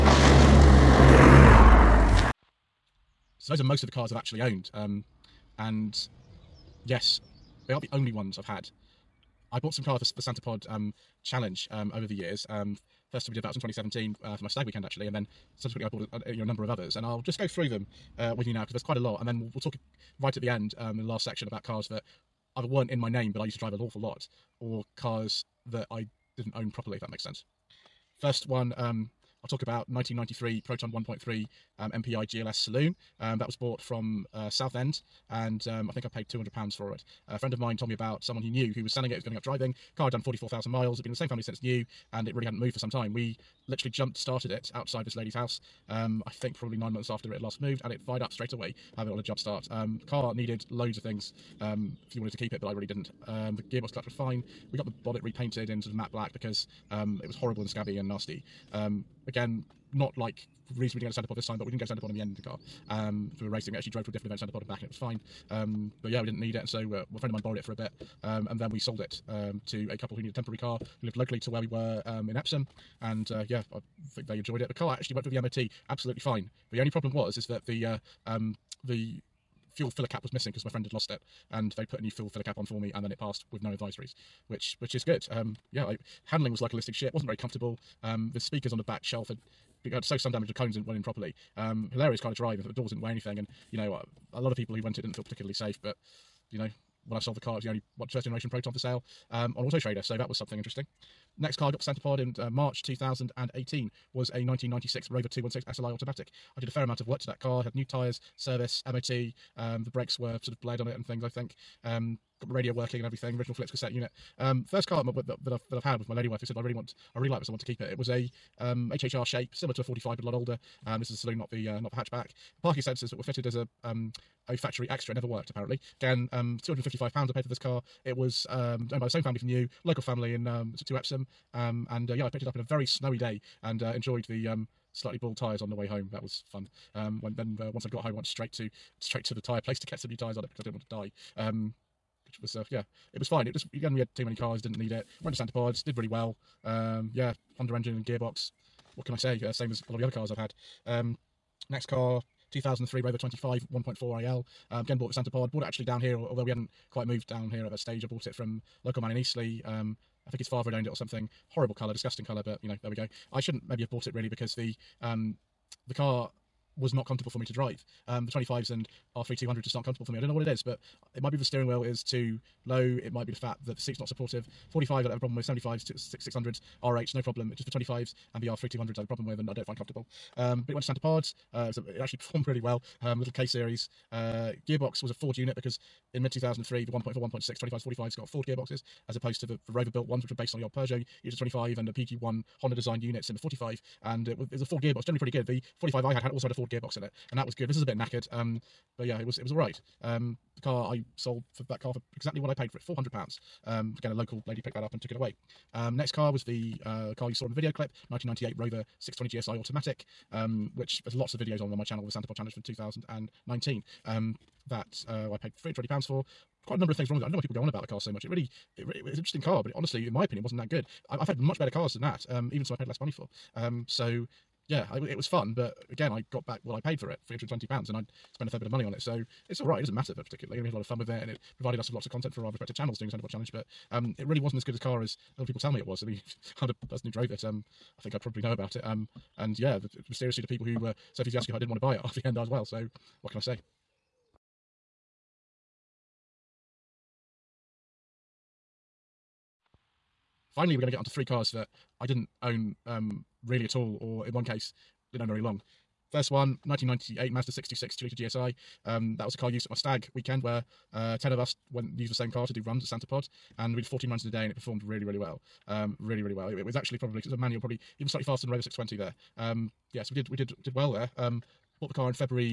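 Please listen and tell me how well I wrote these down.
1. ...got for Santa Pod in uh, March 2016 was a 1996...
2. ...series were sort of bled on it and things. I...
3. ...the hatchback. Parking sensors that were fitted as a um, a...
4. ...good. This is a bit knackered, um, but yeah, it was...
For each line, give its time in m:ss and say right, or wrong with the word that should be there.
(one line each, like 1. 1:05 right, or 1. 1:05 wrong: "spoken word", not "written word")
1. 1:41 wrong: "2018", not "2016"
2. 1:49 wrong: "brakes", not "series"
3. 2:01 right
4. 3:17 right.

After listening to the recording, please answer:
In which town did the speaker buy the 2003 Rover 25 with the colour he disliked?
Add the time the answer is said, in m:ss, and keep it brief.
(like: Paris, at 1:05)
Eastleigh, at 2:39.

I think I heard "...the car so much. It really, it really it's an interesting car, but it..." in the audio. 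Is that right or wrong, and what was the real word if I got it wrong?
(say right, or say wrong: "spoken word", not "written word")
right.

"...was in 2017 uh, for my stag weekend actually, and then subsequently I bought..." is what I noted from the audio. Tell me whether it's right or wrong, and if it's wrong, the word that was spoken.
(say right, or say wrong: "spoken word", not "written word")
right.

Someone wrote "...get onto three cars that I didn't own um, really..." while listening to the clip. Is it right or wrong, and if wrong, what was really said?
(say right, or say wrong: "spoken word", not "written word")
right.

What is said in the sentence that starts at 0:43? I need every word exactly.
We literally jumped started it outside this lady's house.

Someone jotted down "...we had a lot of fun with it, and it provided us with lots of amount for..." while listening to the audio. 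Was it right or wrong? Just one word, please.
wrong.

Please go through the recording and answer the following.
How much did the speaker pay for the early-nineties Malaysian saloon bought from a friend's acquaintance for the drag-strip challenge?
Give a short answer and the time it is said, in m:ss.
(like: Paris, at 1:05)
£200, at 0:36.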